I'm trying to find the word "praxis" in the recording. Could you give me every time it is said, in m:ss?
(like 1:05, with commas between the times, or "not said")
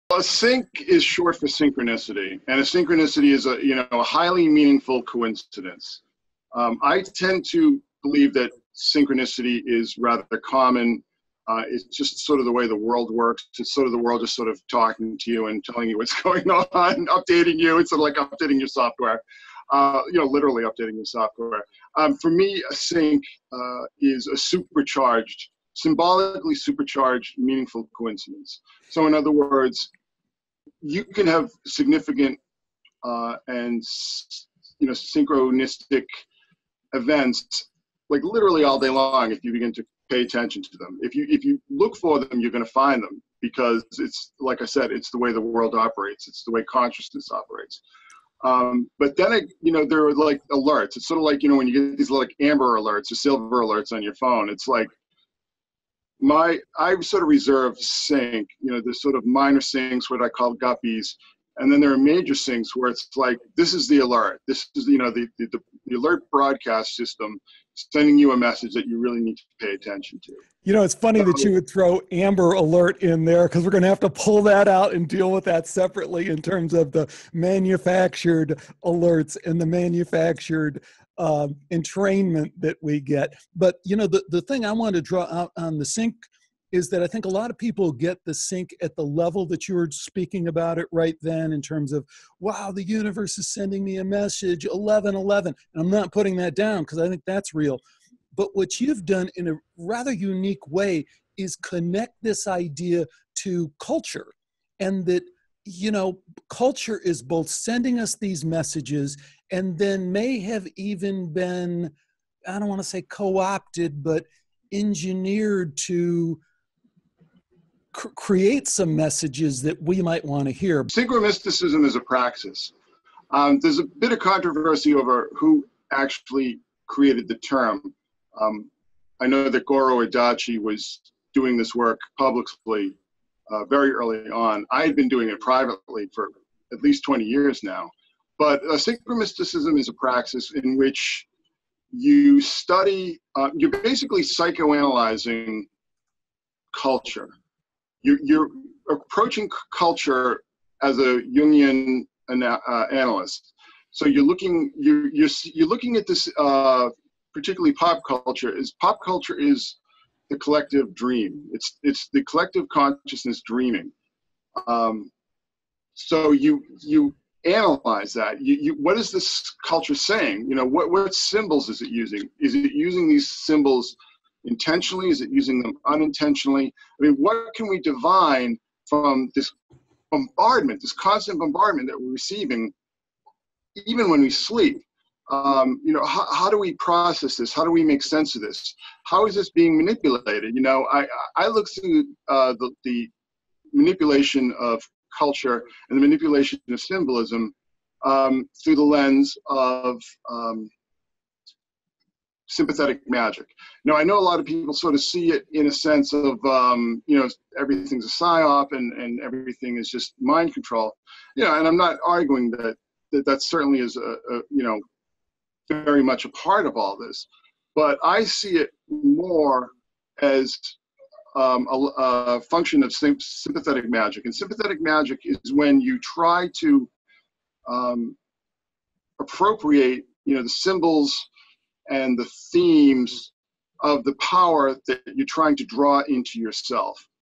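2:02, 2:19.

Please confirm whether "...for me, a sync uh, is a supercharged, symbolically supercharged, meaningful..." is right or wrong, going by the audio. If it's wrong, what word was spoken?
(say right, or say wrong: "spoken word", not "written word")
right.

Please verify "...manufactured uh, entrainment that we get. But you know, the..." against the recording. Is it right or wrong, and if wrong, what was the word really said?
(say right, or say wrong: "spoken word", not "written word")
right.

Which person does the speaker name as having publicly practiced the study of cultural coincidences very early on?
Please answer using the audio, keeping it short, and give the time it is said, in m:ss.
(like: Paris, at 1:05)
Goro Adachi, at 2:09.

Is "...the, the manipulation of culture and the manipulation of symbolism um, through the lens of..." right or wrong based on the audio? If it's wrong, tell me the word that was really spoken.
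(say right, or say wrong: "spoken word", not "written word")
right.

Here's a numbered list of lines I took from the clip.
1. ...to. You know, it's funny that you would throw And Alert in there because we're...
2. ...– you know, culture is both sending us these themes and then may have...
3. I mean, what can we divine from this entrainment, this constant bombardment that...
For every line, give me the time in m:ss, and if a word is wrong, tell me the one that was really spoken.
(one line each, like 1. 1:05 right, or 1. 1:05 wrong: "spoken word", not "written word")
1. 1:10 wrong: "Amber", not "And"
2. 1:45 wrong: "messages", not "themes"
3. 2:56 wrong: "bombardment", not "entrainment".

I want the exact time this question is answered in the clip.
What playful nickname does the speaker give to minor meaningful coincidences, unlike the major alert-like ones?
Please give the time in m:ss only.
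1:00.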